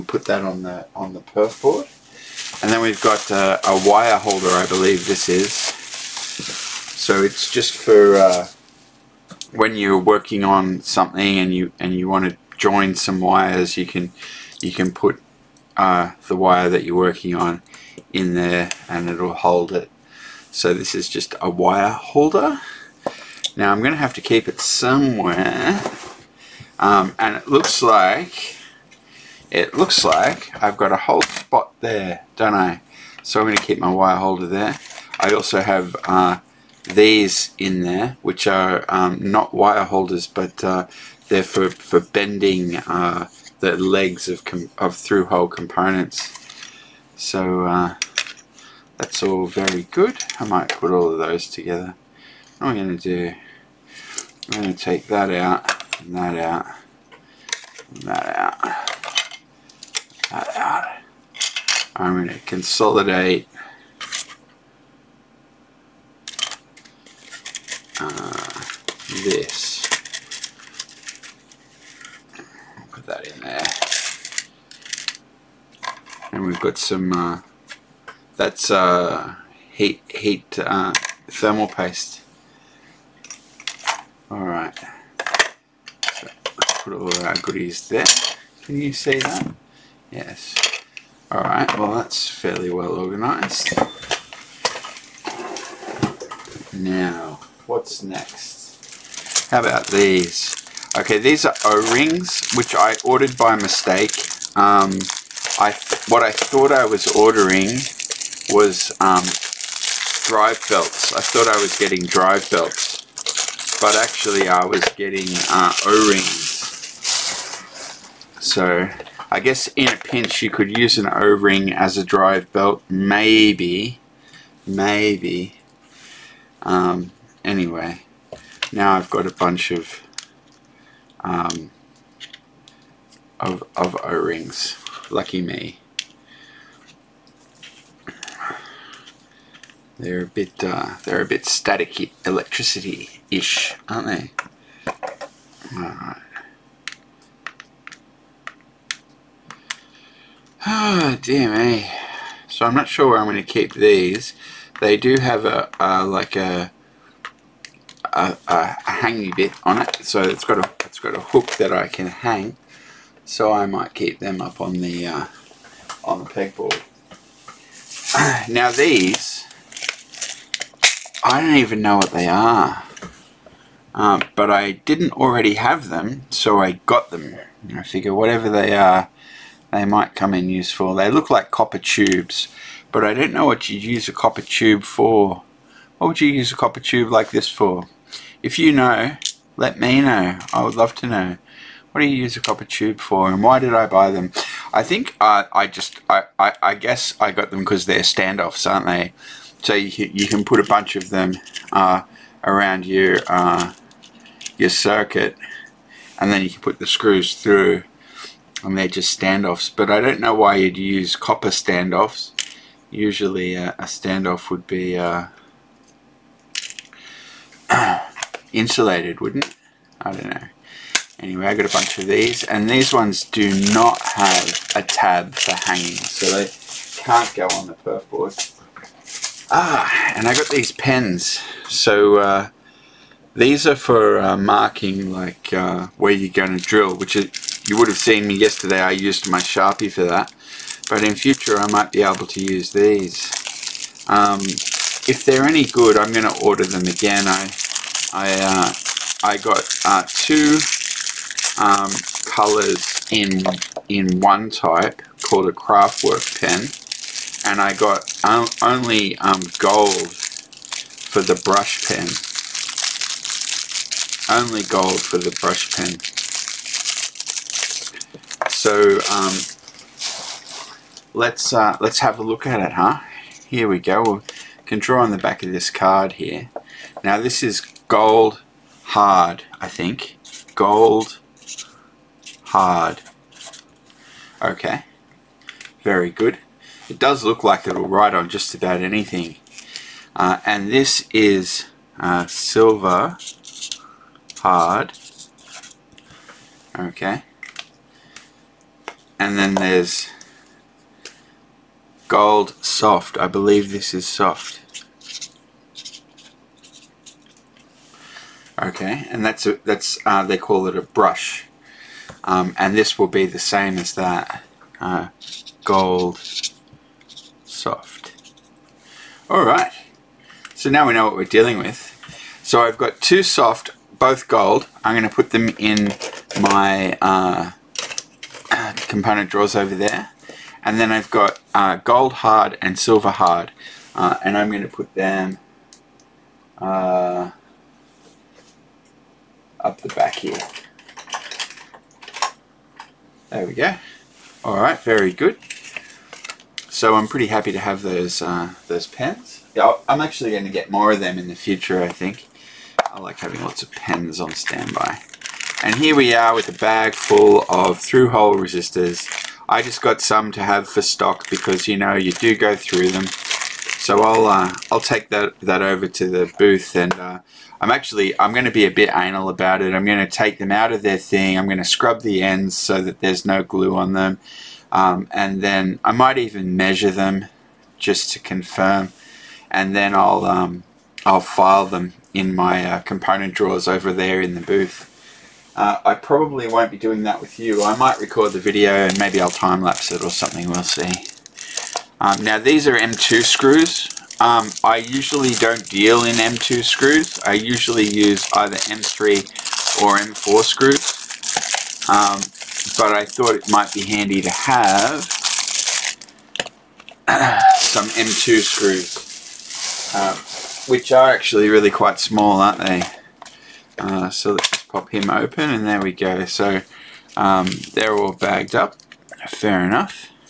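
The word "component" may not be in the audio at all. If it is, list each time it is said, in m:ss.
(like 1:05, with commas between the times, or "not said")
0:45, 5:28, 6:22.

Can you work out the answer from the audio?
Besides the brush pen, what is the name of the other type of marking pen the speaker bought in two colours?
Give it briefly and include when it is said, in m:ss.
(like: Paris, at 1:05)
craftwork pen, at 4:15.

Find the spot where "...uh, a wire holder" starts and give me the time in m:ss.
0:03.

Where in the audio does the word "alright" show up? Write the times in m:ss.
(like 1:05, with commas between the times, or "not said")
1:24, 1:31, 5:19, 5:44.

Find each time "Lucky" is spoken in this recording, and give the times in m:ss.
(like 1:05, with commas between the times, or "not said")
2:15.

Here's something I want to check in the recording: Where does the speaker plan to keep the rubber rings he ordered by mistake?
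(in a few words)
on the pegboard.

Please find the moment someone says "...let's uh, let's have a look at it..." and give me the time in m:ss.
4:31.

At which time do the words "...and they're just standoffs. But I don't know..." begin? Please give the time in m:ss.
3:28.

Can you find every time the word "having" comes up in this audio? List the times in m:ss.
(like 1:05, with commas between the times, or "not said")
5:53.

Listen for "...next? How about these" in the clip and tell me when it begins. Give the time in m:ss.
1:38.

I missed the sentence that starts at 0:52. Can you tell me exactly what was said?
What I'm going to do, I'm going to take that out, and that out, and that out, that out.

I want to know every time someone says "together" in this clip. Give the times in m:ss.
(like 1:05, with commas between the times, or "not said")
0:51.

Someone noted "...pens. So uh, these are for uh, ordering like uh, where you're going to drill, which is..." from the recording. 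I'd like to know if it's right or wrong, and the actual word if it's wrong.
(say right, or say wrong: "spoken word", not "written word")
wrong: "marking", not "ordering".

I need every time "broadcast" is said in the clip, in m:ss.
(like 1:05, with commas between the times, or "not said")
not said.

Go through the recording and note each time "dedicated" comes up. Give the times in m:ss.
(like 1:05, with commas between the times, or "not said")
not said.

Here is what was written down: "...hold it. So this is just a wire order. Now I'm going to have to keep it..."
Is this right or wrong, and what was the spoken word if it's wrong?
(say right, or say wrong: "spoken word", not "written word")
wrong: "holder", not "order".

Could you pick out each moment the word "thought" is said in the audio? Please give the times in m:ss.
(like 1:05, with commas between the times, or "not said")
1:46, 1:51, 6:43.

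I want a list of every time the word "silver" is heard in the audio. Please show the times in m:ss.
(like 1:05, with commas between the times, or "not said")
4:52, 5:32.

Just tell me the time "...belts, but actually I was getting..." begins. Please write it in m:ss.
1:52.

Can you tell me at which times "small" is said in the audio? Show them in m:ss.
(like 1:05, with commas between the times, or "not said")
6:51.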